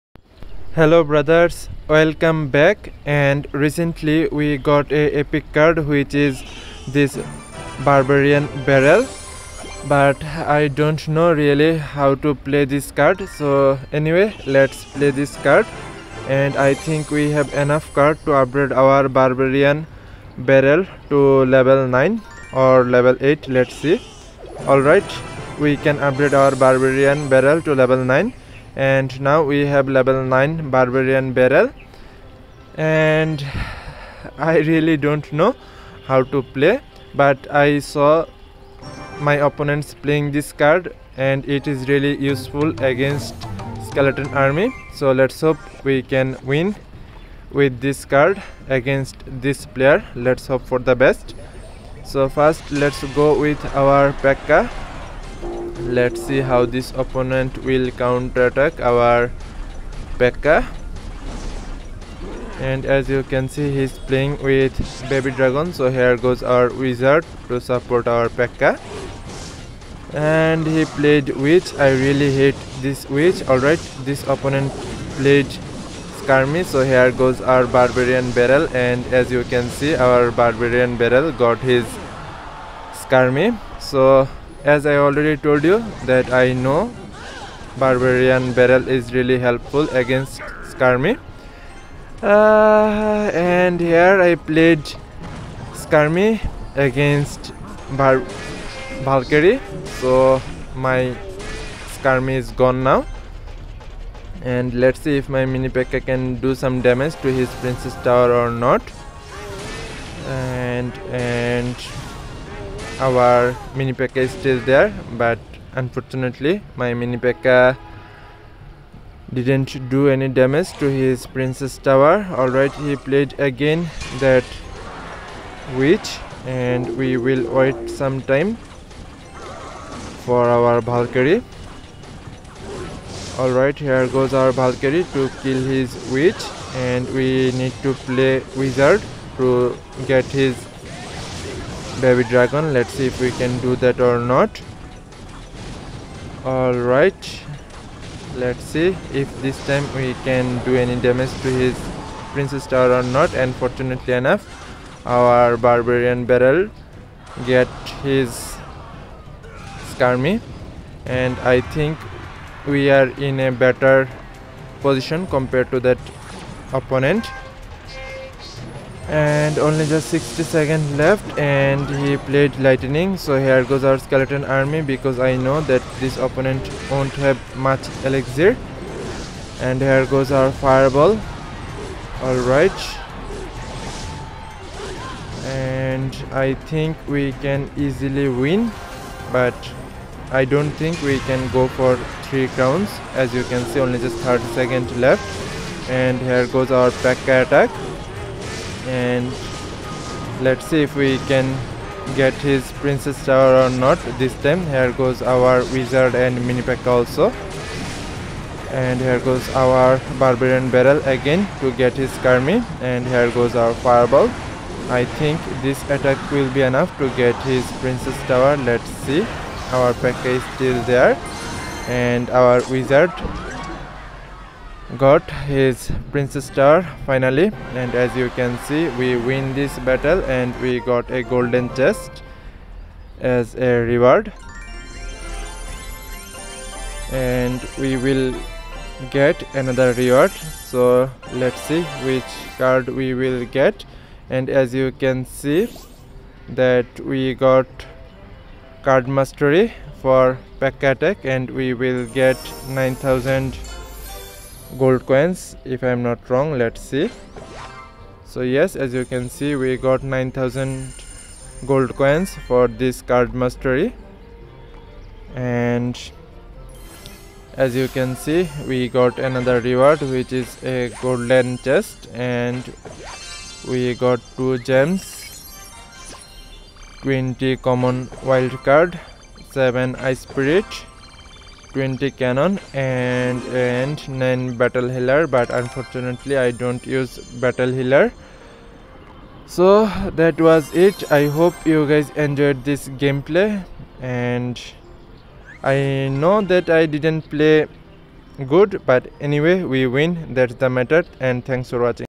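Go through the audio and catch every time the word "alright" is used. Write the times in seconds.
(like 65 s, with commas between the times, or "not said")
73 s, 122 s, 133 s, 182 s.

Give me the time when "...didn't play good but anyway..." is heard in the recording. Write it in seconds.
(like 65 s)
296 s.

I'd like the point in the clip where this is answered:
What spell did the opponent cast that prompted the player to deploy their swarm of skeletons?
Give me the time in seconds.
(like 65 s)
172 s.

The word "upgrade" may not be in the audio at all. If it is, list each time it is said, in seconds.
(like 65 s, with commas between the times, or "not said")
18 s, 25 s.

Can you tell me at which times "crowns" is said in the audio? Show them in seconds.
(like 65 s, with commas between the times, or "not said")
192 s.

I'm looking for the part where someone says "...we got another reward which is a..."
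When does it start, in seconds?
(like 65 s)
268 s.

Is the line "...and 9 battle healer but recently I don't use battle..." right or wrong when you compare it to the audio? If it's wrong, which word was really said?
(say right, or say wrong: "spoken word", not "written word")
wrong: "unfortunately", not "recently".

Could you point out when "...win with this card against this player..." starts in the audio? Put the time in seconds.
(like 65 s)
46 s.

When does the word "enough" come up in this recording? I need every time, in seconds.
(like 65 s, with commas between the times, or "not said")
17 s, 154 s, 216 s.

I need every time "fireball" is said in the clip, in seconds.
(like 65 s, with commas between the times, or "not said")
180 s, 213 s.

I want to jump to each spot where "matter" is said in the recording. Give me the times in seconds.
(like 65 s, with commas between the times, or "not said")
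300 s.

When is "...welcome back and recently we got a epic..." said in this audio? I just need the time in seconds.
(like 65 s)
1 s.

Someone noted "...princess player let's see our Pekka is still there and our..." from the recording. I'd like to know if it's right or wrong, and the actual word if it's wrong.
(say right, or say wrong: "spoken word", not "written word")
wrong: "tower", not "player".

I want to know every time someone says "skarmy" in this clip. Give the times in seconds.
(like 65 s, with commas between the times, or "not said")
76 s, 82 s, 90 s, 95 s, 102 s, 159 s, 212 s.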